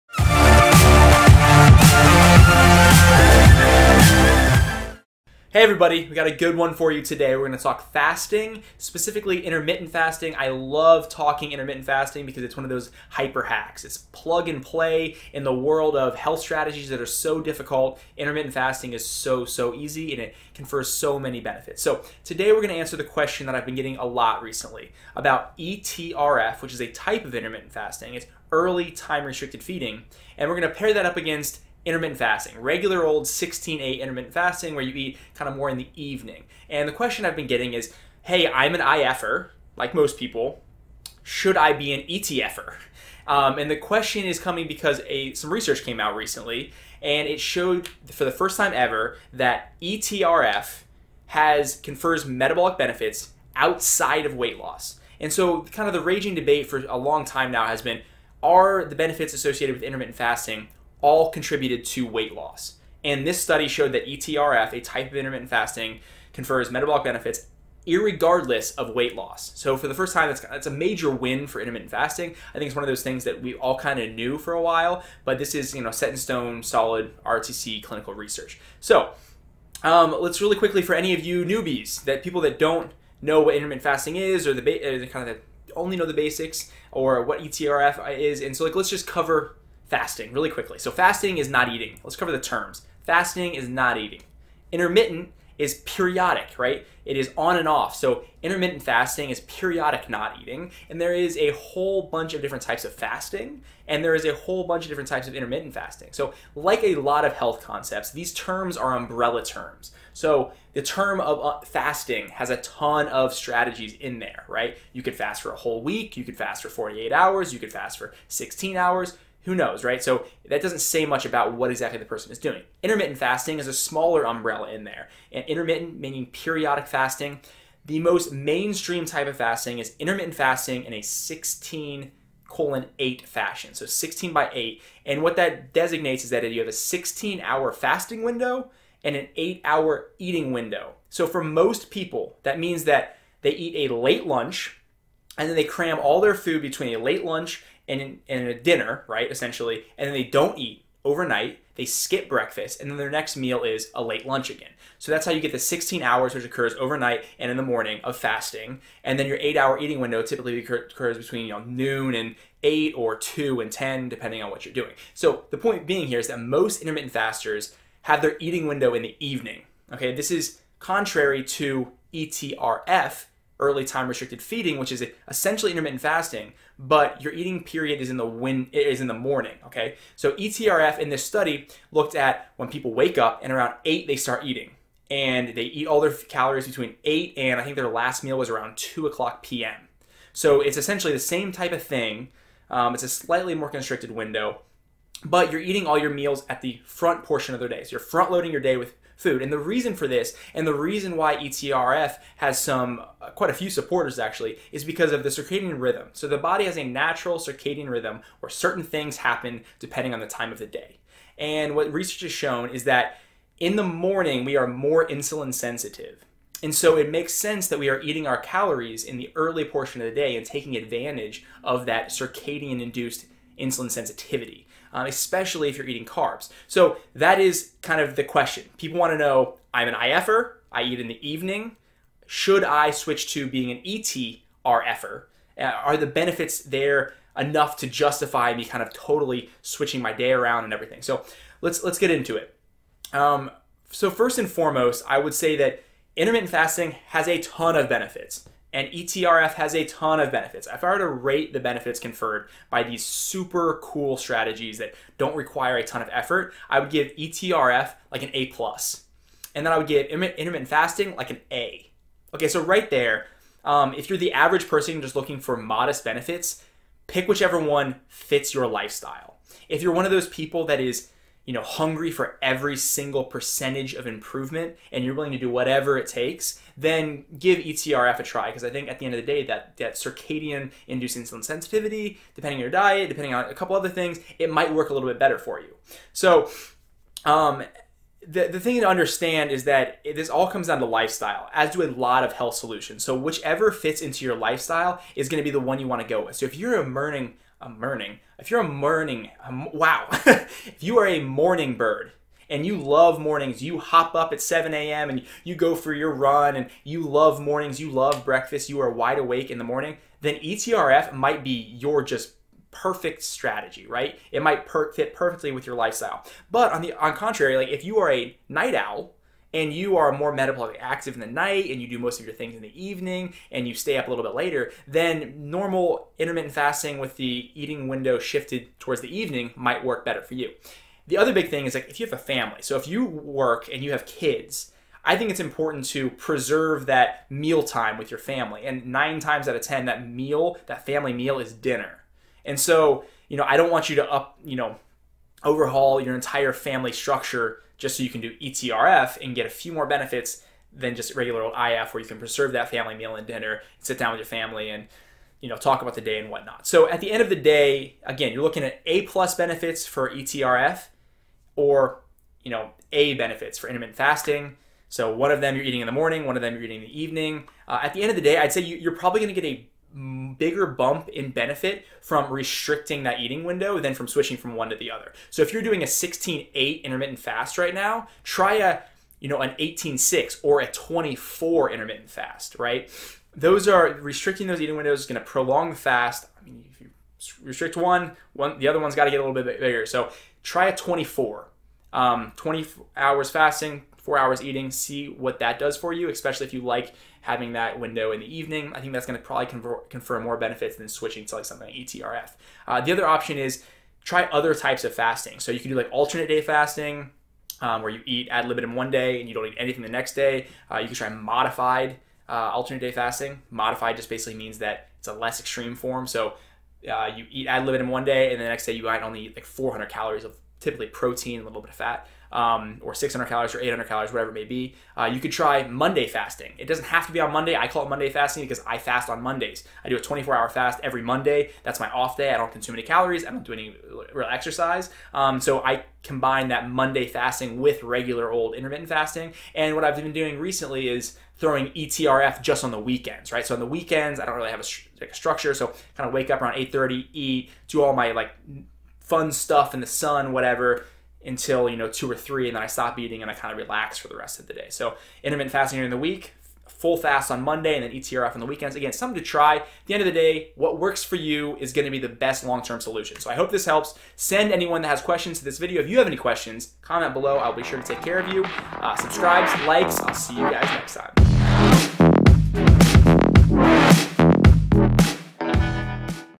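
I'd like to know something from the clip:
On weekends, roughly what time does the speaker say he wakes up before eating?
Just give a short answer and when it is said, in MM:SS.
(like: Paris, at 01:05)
8:30, at 07:26.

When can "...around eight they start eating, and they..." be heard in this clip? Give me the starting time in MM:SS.
03:03.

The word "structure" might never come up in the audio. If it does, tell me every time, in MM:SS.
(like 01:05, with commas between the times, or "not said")
05:46, 07:25.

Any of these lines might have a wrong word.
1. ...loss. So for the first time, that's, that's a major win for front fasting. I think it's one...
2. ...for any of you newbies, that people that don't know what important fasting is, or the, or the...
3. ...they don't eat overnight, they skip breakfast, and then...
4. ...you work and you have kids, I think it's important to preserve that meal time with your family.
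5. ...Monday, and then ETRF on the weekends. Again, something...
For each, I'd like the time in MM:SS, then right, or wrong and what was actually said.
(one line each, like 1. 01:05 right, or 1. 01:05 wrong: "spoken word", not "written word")
1. 01:09 wrong: "intermittent", not "front"
2. 01:20 wrong: "intermittent", not "important"
3. 02:30 right
4. 05:32 right
5. 07:37 right.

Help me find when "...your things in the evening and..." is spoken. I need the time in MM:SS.
05:22.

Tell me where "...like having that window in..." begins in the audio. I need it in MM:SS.
06:36.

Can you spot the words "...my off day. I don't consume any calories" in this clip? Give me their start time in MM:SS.
07:11.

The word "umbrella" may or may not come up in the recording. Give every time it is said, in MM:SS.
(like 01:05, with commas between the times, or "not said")
01:48, 02:04.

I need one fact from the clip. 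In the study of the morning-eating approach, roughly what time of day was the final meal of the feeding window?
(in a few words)
2 p.m.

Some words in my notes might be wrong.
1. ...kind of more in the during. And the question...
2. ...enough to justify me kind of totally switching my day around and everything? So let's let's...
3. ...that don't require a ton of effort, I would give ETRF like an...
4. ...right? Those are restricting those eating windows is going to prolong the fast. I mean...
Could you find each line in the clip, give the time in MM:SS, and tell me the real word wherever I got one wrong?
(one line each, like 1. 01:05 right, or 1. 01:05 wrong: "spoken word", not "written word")
1. 00:35 wrong: "evening", not "during"
2. 03:57 right
3. 04:14 right
4. 06:22 right.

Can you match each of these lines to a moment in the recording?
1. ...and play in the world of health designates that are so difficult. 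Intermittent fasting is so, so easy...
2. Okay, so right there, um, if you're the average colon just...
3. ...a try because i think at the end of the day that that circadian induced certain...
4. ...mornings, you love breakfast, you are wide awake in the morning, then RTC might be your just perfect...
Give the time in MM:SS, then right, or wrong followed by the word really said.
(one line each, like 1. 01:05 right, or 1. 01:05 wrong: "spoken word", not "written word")
1. 00:14 wrong: "strategies", not "designates"
2. 04:22 wrong: "person", not "colon"
3. 04:38 wrong: "insulin", not "certain"
4. 05:07 wrong: "ETRF", not "RTC".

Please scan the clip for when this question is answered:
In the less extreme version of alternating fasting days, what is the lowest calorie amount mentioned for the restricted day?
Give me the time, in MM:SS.
06:59.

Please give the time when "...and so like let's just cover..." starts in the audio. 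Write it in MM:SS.
01:28.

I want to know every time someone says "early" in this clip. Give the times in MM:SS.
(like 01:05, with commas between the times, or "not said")
00:28, 02:53, 03:39.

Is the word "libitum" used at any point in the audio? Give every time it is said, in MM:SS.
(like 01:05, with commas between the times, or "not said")
06:48, 06:57.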